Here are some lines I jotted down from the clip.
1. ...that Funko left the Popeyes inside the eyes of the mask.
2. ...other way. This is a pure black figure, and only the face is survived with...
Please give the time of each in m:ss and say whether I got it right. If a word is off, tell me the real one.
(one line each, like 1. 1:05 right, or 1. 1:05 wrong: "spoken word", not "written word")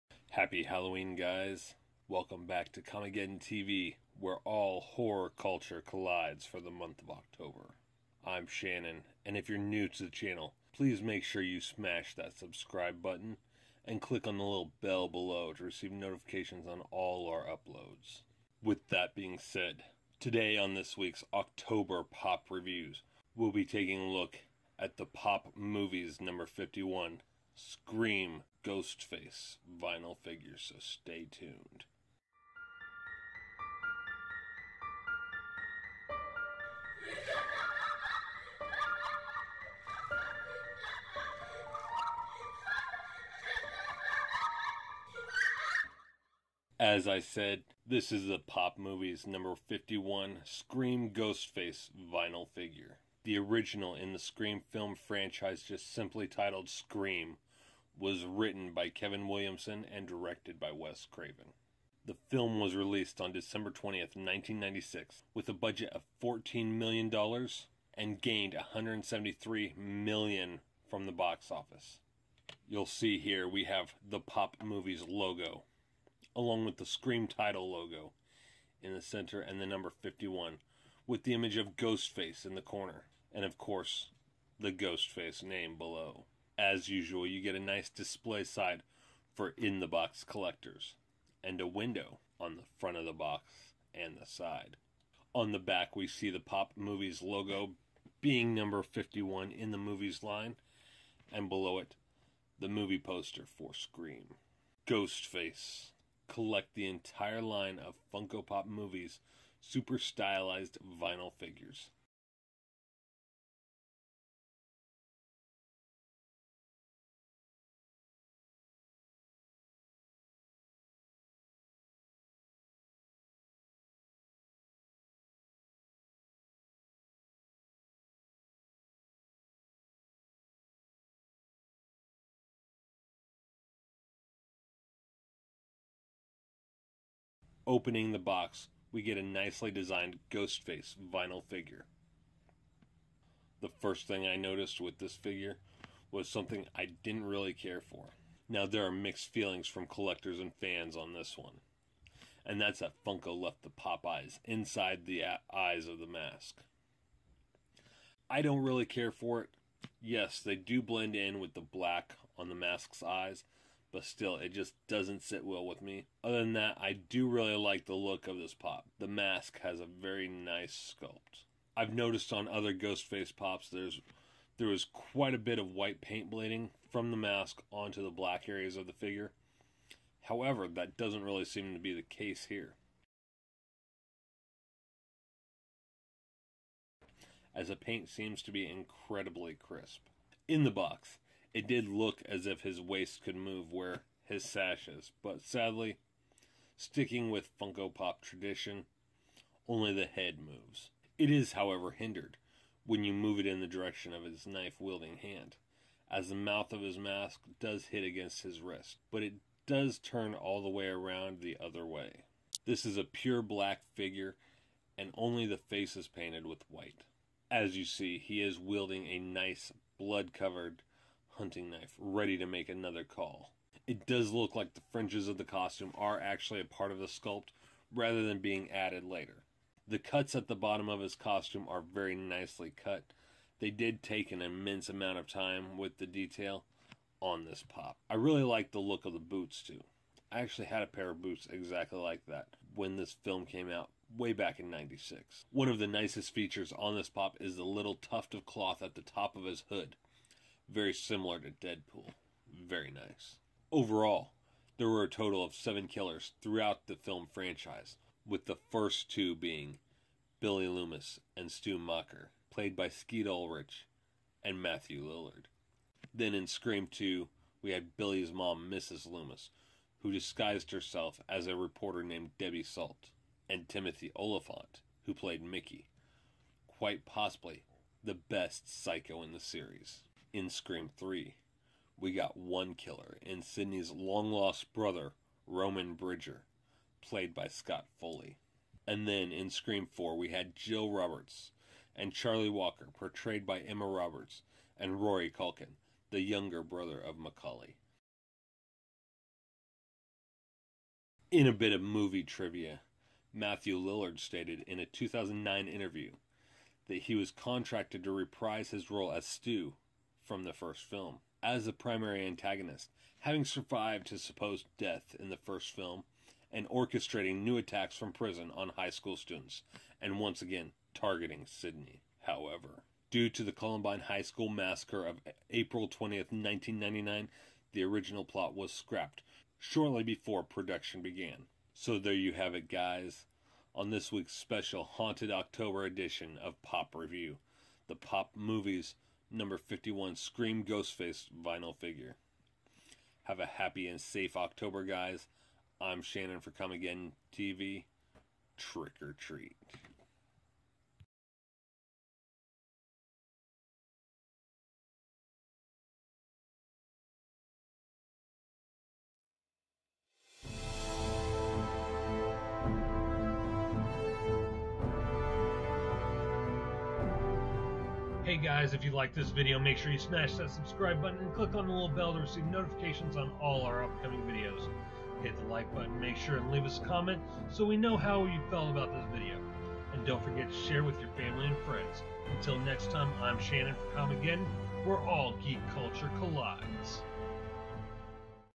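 1. 2:32 right
2. 3:31 wrong: "painted", not "survived".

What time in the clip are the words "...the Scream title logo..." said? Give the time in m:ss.
1:16.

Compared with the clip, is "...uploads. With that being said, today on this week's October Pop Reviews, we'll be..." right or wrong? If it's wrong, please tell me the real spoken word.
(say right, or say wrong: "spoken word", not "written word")
right.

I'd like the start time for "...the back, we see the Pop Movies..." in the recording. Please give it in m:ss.
1:35.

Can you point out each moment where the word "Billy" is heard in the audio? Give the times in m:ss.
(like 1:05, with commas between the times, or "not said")
4:20, 4:27.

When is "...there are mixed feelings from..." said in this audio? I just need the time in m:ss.
2:28.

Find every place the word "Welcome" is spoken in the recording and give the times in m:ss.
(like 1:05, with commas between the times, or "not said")
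0:02.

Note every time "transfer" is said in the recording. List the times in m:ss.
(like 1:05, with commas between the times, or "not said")
not said.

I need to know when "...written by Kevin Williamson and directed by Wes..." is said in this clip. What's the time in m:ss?
0:58.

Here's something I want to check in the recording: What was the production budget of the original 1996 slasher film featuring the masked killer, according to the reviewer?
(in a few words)
$14 million.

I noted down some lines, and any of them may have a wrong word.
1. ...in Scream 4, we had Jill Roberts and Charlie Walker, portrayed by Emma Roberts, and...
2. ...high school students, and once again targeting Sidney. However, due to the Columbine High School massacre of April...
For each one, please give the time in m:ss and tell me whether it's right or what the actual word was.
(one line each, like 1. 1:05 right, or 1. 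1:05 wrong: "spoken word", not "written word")
1. 4:49 right
2. 5:18 right.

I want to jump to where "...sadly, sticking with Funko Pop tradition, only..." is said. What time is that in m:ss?
3:15.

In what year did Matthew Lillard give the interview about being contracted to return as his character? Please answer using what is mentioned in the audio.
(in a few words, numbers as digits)
2009.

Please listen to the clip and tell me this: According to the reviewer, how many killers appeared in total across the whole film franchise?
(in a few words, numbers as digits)
7.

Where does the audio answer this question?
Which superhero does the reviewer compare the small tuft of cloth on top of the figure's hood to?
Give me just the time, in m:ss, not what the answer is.
4:11.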